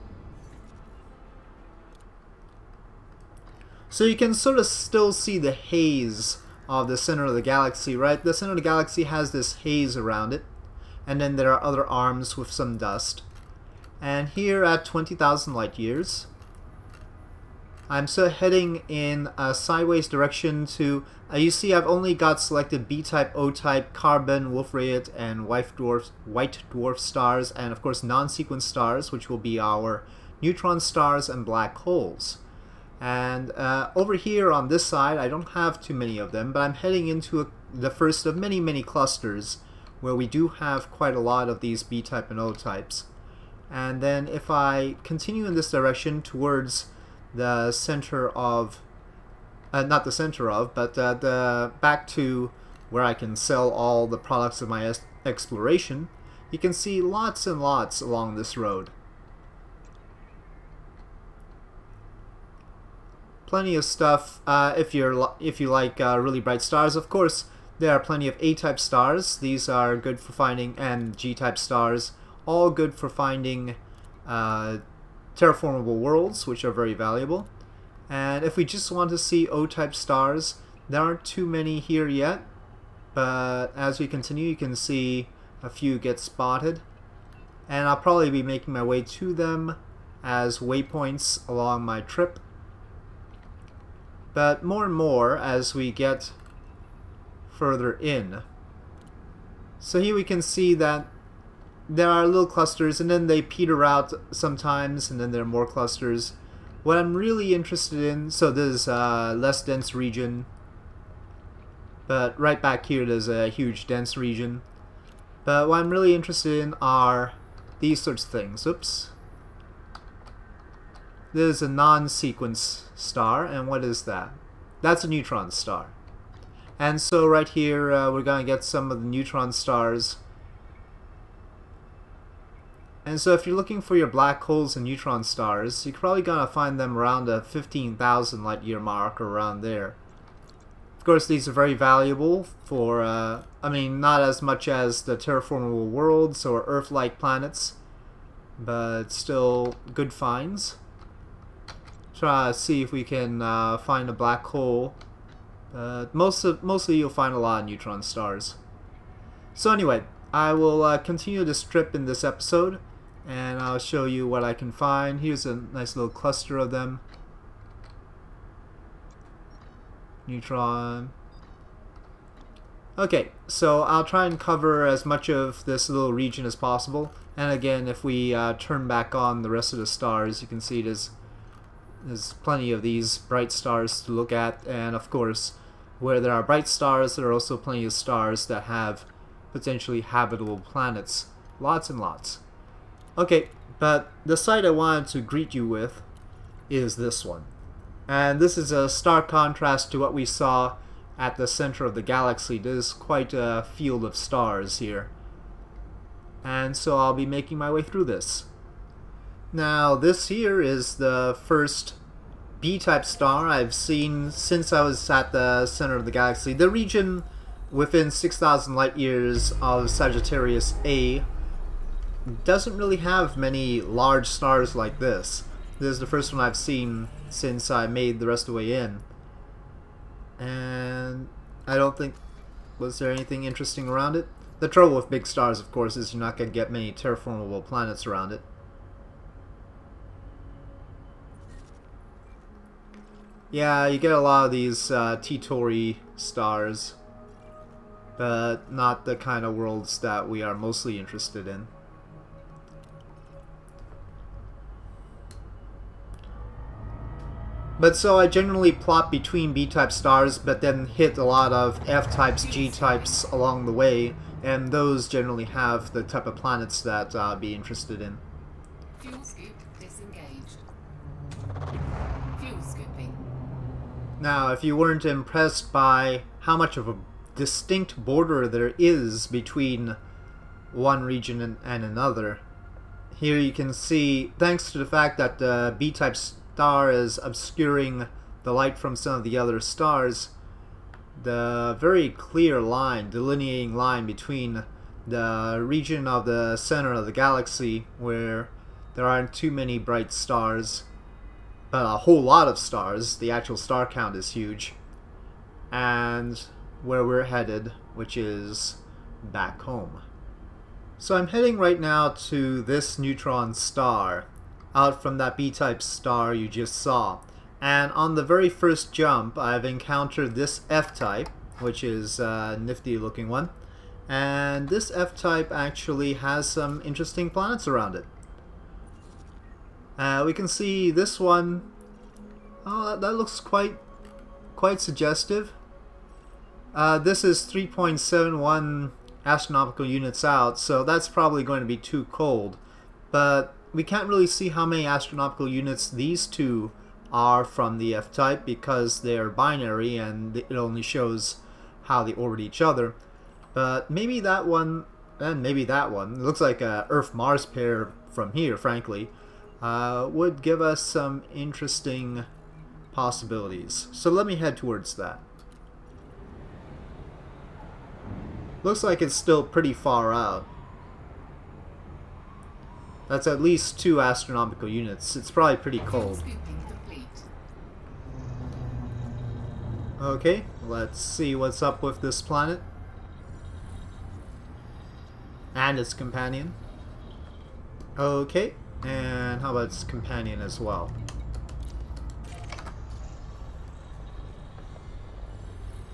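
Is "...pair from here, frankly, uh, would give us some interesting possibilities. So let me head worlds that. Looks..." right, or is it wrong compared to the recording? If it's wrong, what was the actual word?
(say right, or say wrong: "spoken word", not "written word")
wrong: "towards", not "worlds".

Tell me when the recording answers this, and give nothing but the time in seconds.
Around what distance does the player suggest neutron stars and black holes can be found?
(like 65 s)
137 s.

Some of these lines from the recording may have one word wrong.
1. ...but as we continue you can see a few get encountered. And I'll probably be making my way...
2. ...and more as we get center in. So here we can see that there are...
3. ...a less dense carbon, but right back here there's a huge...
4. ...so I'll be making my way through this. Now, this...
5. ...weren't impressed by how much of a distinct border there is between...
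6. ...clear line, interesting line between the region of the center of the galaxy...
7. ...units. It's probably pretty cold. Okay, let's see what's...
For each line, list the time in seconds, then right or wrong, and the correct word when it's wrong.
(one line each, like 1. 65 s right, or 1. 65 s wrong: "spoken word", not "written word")
1. 83 s wrong: "spotted", not "encountered"
2. 94 s wrong: "further", not "center"
3. 108 s wrong: "region", not "carbon"
4. 206 s right
5. 274 s right
6. 292 s wrong: "delineating", not "interesting"
7. 374 s right.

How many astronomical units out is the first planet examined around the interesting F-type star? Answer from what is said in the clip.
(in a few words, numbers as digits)
3.71.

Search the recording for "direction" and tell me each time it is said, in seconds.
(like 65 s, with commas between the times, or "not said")
20 s, 45 s.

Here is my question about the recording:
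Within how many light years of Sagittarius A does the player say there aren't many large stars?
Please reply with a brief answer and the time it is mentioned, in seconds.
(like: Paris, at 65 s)
6,000, at 218 s.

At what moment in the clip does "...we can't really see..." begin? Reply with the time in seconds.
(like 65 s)
343 s.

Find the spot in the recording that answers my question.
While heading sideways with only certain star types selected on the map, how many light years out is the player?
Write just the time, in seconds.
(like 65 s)
14 s.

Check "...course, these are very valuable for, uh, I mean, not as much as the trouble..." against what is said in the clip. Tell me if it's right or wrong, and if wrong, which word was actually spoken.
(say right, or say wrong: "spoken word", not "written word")
wrong: "terraformable", not "trouble".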